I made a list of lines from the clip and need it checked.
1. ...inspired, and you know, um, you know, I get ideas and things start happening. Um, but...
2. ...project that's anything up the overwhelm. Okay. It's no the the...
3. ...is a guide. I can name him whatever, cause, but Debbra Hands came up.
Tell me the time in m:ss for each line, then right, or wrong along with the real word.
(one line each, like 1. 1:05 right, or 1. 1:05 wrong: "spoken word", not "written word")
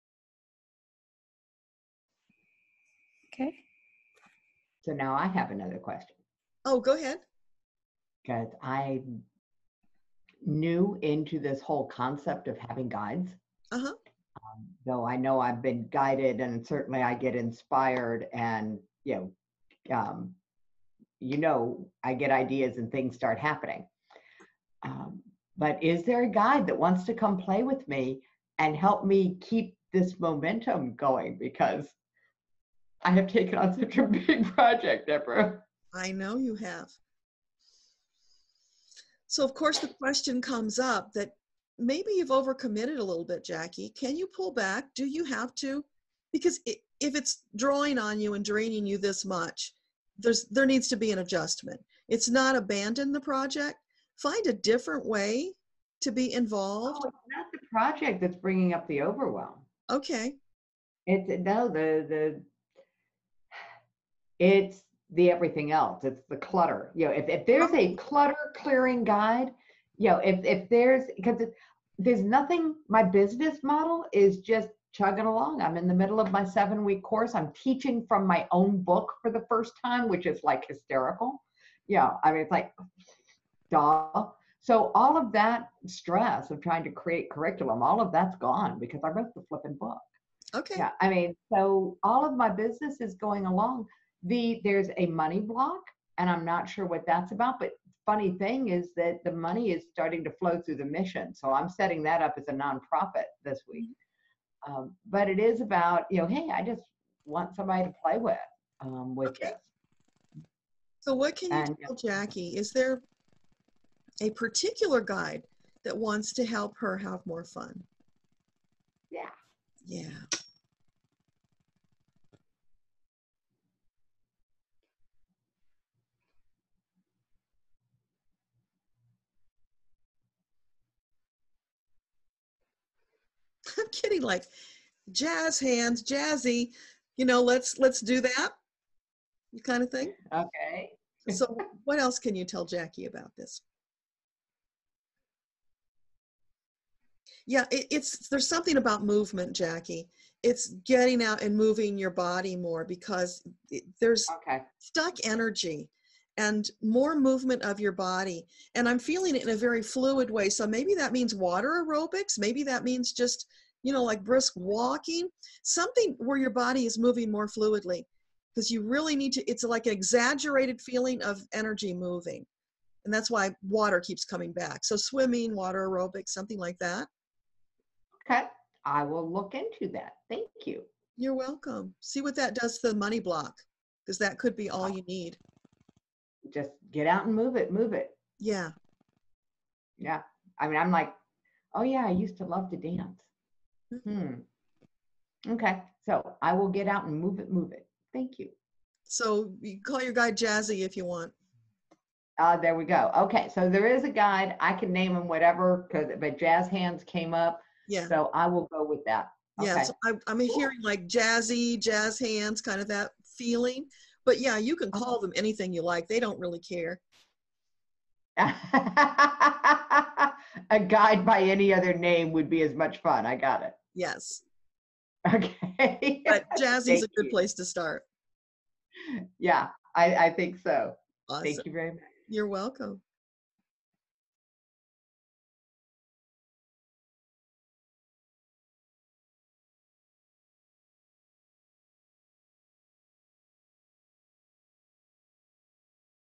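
1. 0:17 right
2. 0:57 wrong: "bringing", not "anything"
3. 3:23 wrong: "Jazz", not "Debbra".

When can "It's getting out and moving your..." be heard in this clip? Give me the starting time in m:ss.
2:30.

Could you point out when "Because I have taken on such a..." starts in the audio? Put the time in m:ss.
0:31.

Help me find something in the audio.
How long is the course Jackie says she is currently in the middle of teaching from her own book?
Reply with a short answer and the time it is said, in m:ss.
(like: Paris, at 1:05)
7 weeks, at 1:16.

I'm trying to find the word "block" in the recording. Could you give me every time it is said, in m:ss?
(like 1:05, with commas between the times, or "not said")
1:35, 3:03.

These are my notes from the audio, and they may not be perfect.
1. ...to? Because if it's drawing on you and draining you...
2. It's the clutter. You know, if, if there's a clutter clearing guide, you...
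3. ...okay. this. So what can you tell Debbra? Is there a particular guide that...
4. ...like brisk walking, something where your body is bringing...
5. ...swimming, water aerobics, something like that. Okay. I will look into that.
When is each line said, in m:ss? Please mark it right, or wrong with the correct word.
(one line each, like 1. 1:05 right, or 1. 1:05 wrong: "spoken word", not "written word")
1. 0:45 right
2. 1:06 right
3. 1:49 wrong: "Jackie", not "Debbra"
4. 2:44 wrong: "moving", not "bringing"
5. 2:54 right.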